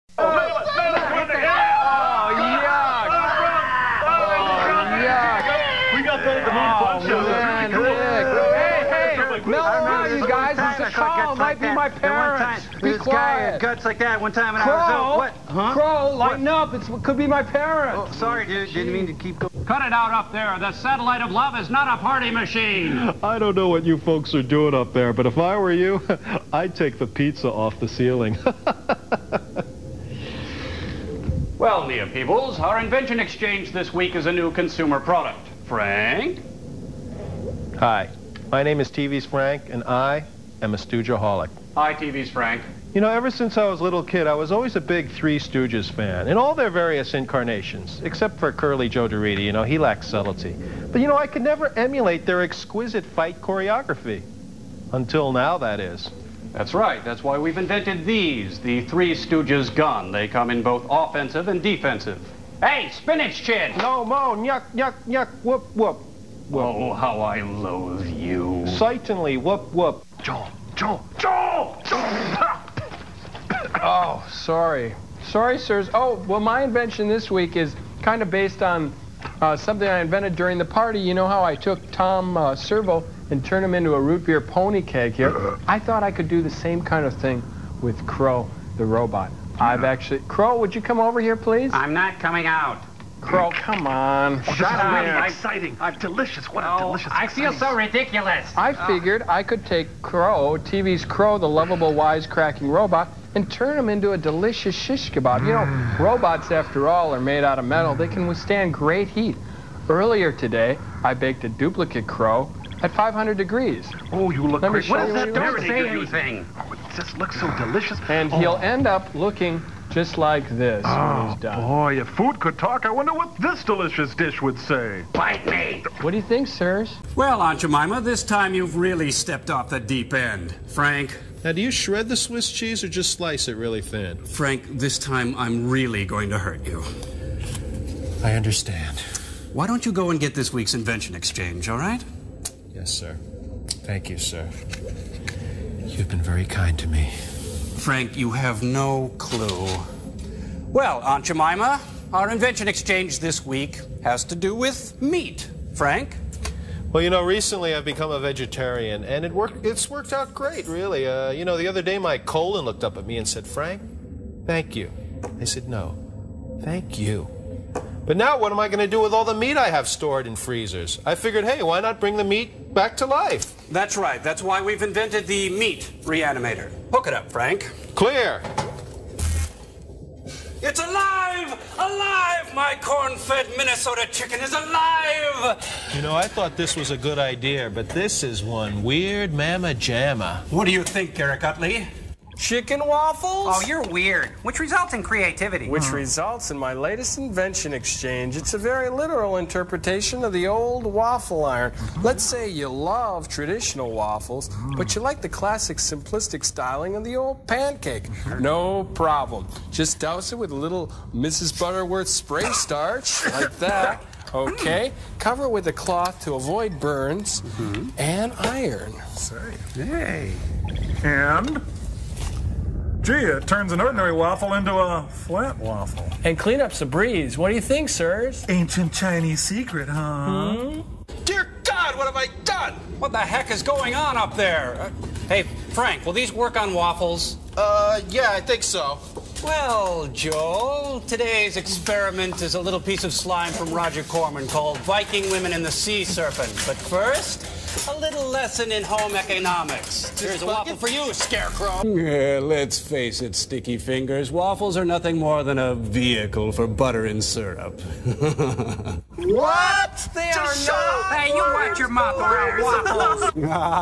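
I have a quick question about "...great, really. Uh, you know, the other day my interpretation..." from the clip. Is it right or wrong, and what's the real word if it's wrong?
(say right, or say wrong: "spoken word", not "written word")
wrong: "colon", not "interpretation".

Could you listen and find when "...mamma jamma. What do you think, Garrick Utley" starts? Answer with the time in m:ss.
3:09.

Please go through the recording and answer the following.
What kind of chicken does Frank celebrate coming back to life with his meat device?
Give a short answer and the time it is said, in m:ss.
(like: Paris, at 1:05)
corn-fed Minnesota chicken, at 3:02.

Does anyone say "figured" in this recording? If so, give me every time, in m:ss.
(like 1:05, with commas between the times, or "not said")
1:38, 2:51.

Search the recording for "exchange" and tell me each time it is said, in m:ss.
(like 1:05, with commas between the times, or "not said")
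0:33, 2:21, 2:32, 3:17.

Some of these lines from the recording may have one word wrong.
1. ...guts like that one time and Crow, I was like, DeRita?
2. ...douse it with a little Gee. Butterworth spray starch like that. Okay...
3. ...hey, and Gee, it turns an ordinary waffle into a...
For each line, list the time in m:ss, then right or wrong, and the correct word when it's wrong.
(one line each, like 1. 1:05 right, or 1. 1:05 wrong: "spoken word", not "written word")
1. 0:13 wrong: "What", not "DeRita"
2. 3:29 wrong: "Mrs", not "Gee"
3. 3:39 right.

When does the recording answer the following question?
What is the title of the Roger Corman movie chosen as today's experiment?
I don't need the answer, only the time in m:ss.
4:04.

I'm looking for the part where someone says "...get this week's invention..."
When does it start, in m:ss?
2:20.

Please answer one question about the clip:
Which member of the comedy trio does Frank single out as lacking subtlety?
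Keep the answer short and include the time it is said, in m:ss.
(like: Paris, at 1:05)
Curly Joe DeRita, at 0:48.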